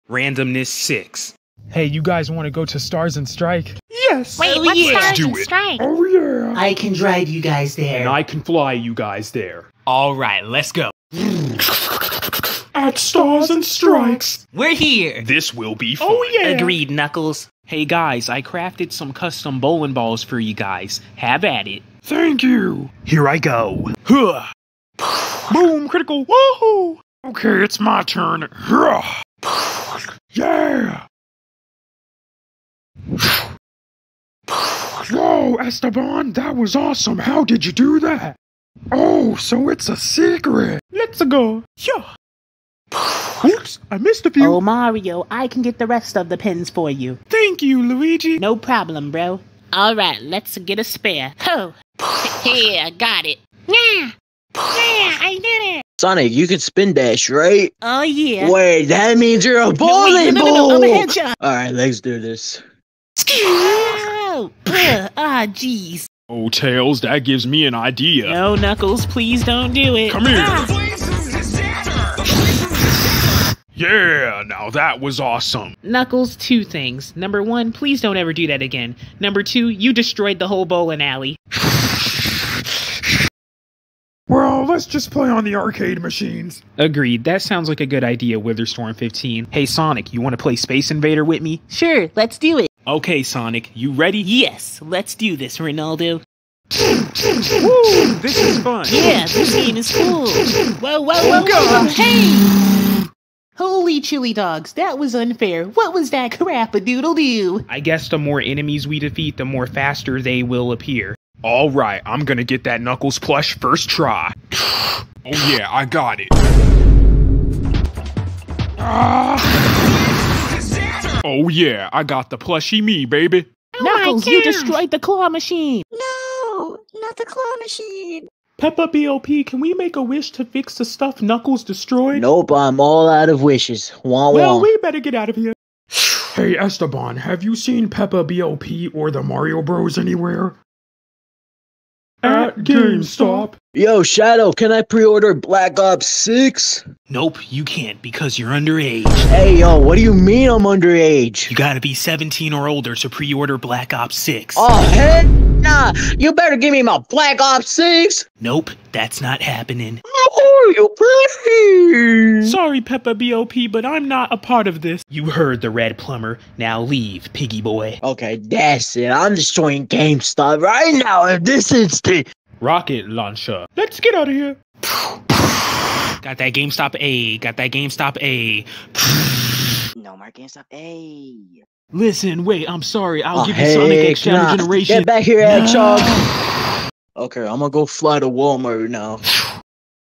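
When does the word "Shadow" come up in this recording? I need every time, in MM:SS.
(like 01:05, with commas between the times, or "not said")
02:24, 03:04.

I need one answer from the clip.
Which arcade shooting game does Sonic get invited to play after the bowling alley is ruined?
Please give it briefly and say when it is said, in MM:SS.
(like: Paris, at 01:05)
Space Invader, at 01:30.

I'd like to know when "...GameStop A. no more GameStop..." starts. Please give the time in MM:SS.
02:57.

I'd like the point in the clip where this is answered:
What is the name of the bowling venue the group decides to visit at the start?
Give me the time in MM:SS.
00:12.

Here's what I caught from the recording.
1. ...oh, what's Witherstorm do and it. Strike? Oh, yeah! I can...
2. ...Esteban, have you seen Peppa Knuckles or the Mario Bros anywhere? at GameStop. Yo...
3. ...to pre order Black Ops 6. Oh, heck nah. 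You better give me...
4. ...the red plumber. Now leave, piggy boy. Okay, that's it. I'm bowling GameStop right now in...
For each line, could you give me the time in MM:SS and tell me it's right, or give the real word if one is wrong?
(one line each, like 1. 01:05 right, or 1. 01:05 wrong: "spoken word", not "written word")
1. 00:04 wrong: "Stars", not "Witherstorm"
2. 02:16 wrong: "BOP", not "Knuckles"
3. 02:32 right
4. 02:45 wrong: "destroying", not "bowling".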